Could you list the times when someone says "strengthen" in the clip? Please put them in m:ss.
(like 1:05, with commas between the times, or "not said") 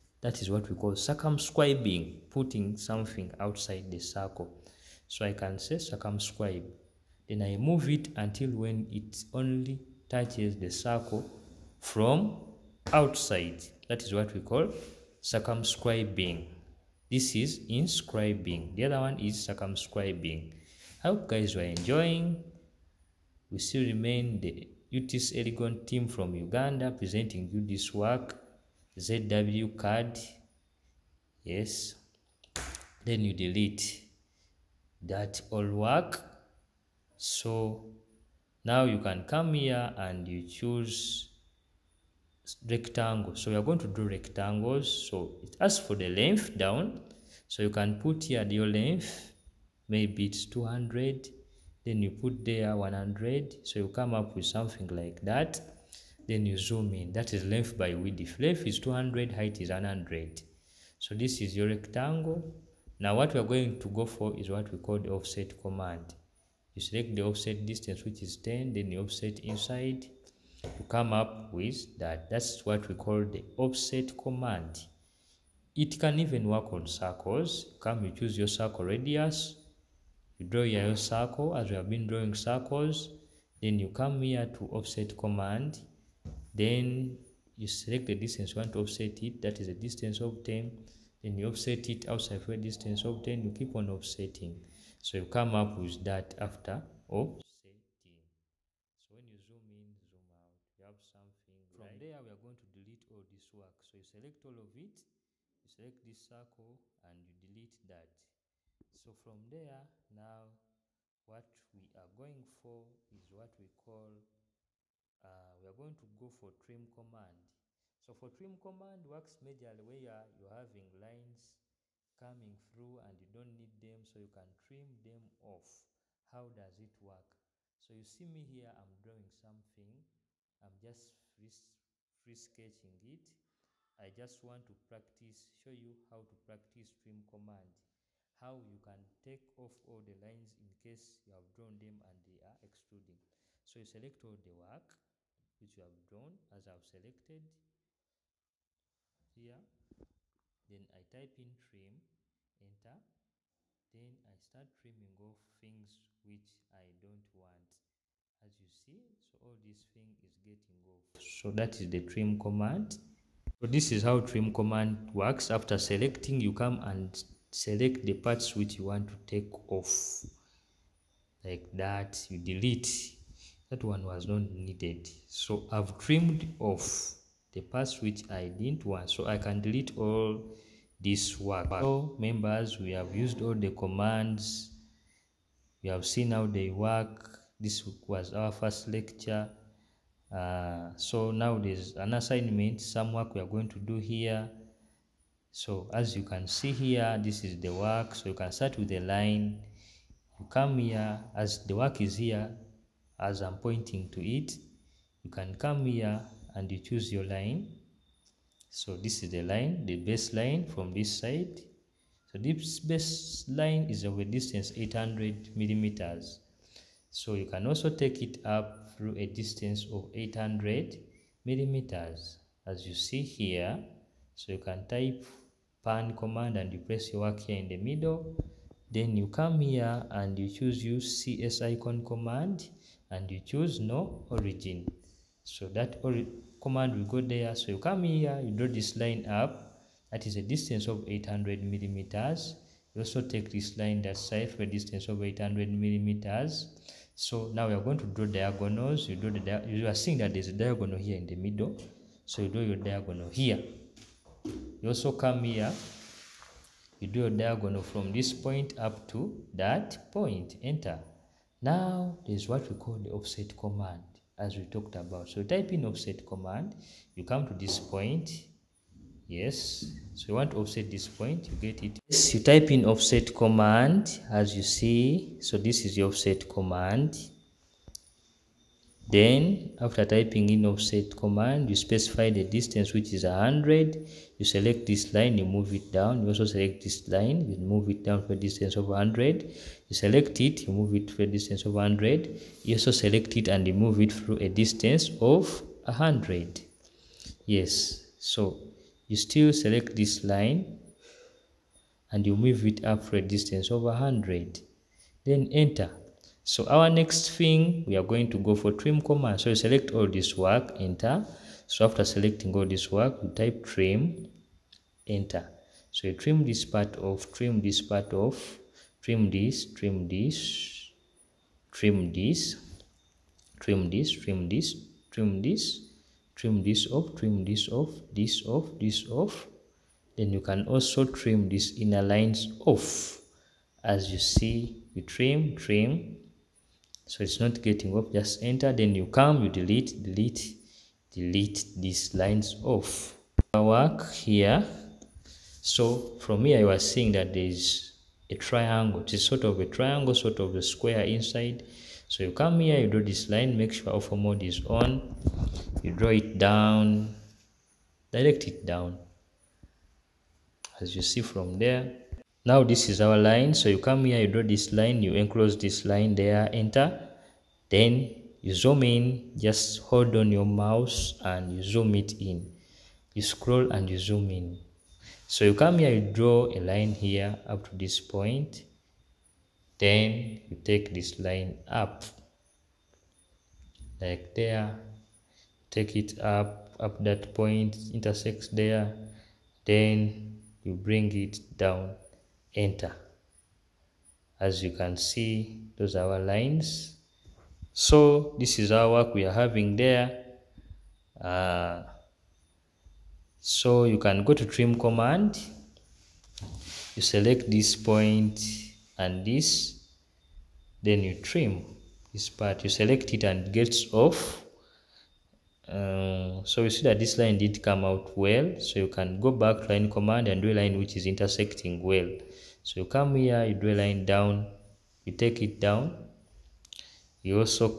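not said.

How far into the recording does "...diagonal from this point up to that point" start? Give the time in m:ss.
4:17.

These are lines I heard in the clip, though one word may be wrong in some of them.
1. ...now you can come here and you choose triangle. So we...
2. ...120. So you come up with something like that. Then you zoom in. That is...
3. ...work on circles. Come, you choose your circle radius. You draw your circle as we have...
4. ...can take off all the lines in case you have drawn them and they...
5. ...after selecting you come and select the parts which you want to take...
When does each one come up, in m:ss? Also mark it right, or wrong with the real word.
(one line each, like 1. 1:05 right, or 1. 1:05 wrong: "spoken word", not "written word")
1. 0:38 wrong: "rectangle", not "triangle"
2. 0:52 wrong: "100", not "120"
3. 1:16 right
4. 2:18 right
5. 2:45 right.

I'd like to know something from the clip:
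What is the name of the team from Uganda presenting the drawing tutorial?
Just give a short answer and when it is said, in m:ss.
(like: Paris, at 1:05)
UTC Elgon, at 0:24.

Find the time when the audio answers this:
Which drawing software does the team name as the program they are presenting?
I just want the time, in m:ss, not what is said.
0:29.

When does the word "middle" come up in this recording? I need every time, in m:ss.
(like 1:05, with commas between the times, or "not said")
3:47, 4:11.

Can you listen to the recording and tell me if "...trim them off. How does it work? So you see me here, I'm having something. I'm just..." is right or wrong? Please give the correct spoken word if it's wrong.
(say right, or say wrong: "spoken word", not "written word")
wrong: "drawing", not "having".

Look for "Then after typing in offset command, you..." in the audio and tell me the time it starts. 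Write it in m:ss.
4:39.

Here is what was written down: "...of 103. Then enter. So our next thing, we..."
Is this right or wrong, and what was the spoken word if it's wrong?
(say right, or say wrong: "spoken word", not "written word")
wrong: "100", not "103".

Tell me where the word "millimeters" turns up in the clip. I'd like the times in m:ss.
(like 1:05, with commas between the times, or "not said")
3:35, 3:41, 4:01, 4:05.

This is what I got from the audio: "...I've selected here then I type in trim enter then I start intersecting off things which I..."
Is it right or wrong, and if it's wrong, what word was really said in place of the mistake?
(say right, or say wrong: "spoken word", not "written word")
wrong: "trimming", not "intersecting".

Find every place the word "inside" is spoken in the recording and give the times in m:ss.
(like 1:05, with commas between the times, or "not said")
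1:09, 5:51.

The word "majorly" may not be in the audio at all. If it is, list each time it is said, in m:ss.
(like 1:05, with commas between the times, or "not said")
1:59.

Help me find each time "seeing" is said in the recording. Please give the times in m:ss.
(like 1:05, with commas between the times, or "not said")
4:09, 5:46.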